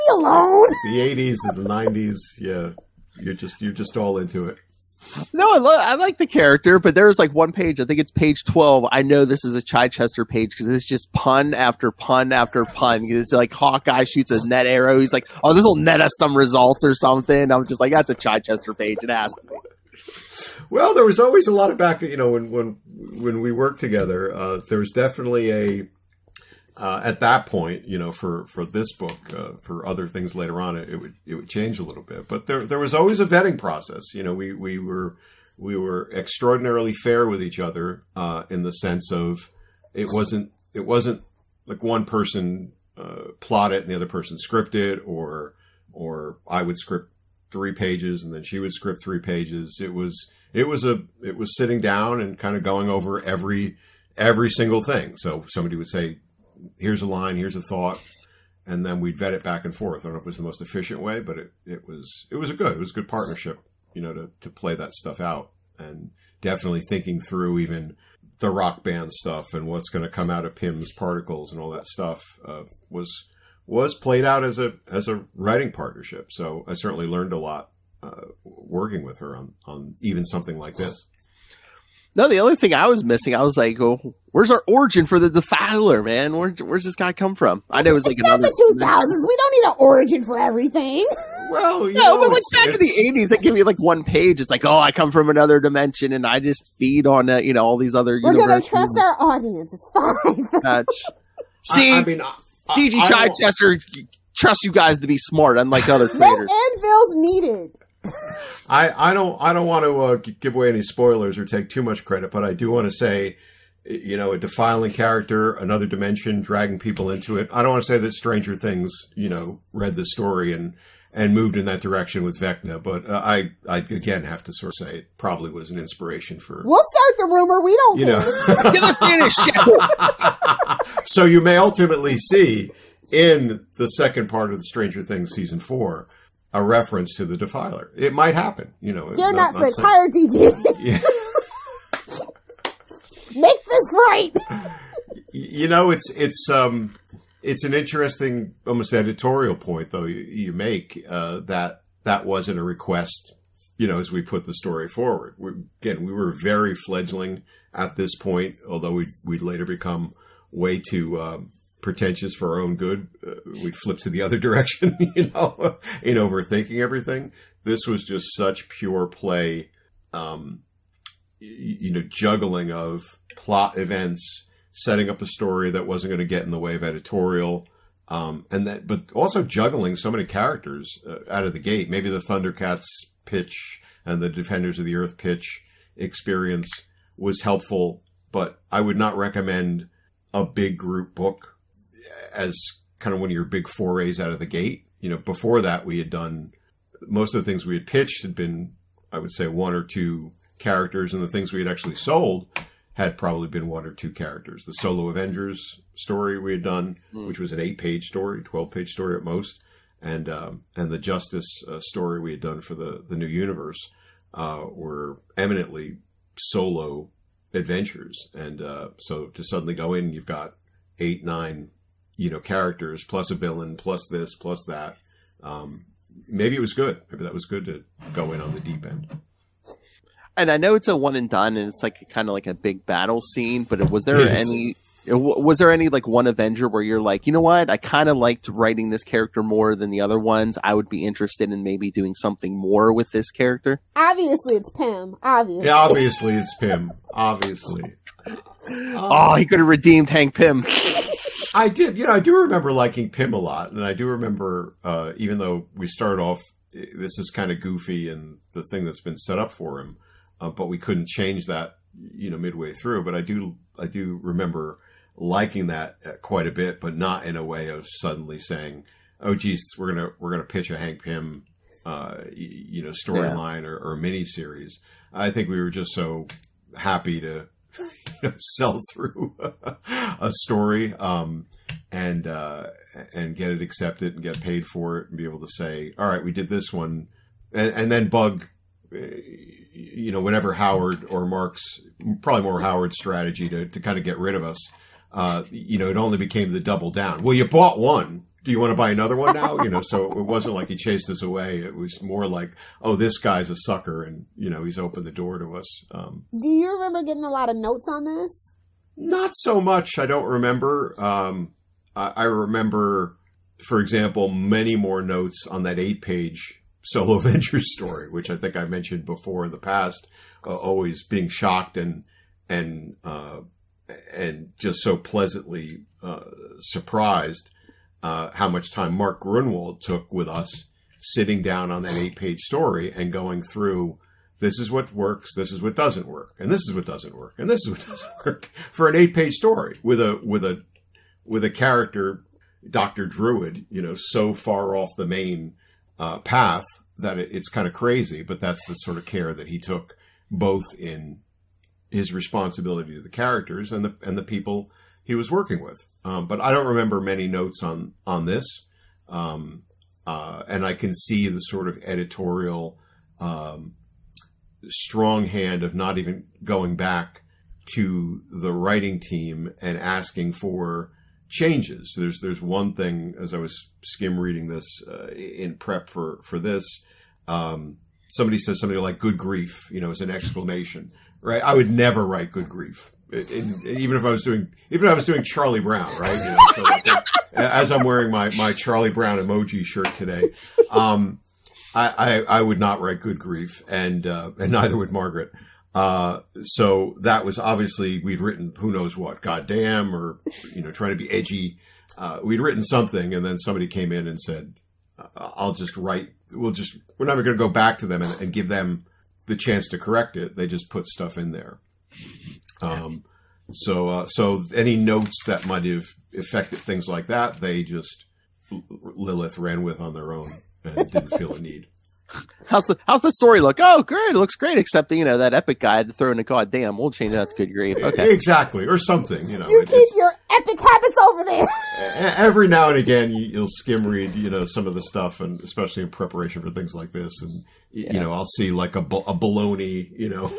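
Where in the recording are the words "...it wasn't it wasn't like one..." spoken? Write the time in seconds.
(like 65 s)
39 s.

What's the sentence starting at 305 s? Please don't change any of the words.
Um, do you remember getting a lot of notes on this?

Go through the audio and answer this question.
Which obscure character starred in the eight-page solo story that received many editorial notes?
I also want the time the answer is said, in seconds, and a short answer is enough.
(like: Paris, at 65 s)
Dr. Druid, at 342 s.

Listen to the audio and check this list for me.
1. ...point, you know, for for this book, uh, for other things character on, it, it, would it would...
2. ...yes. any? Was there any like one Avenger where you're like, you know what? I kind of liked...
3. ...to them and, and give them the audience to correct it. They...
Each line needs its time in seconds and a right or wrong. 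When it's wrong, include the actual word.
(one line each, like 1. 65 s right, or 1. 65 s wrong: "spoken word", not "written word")
1. 27 s wrong: "later", not "character"
2. 234 s right
3. 407 s wrong: "chance", not "audience".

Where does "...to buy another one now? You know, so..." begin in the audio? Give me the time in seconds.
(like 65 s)
298 s.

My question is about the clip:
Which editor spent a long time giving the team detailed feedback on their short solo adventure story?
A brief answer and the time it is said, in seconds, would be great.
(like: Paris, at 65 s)
Mark Gruenwald, at 328 s.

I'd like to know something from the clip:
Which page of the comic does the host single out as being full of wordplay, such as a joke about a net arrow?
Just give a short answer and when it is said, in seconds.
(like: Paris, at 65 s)
page 12, at 8 s.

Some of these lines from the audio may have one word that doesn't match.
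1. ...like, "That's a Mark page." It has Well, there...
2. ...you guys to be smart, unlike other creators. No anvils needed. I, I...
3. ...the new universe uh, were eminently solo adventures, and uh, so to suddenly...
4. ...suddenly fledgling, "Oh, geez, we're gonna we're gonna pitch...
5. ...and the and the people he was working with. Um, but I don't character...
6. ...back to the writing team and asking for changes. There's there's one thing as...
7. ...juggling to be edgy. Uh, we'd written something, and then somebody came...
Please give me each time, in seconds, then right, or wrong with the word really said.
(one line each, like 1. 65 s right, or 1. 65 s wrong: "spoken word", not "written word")
1. 17 s wrong: "Chichester", not "Mark"
2. 104 s right
3. 213 s right
4. 267 s wrong: "saying", not "fledgling"
5. 353 s wrong: "remember", not "character"
6. 366 s right
7. 400 s wrong: "trying", not "juggling".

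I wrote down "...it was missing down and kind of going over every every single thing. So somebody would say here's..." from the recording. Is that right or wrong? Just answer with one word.
wrong.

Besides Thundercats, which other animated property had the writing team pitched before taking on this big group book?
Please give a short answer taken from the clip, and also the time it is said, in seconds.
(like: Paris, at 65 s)
Defenders of the Earth, at 184 s.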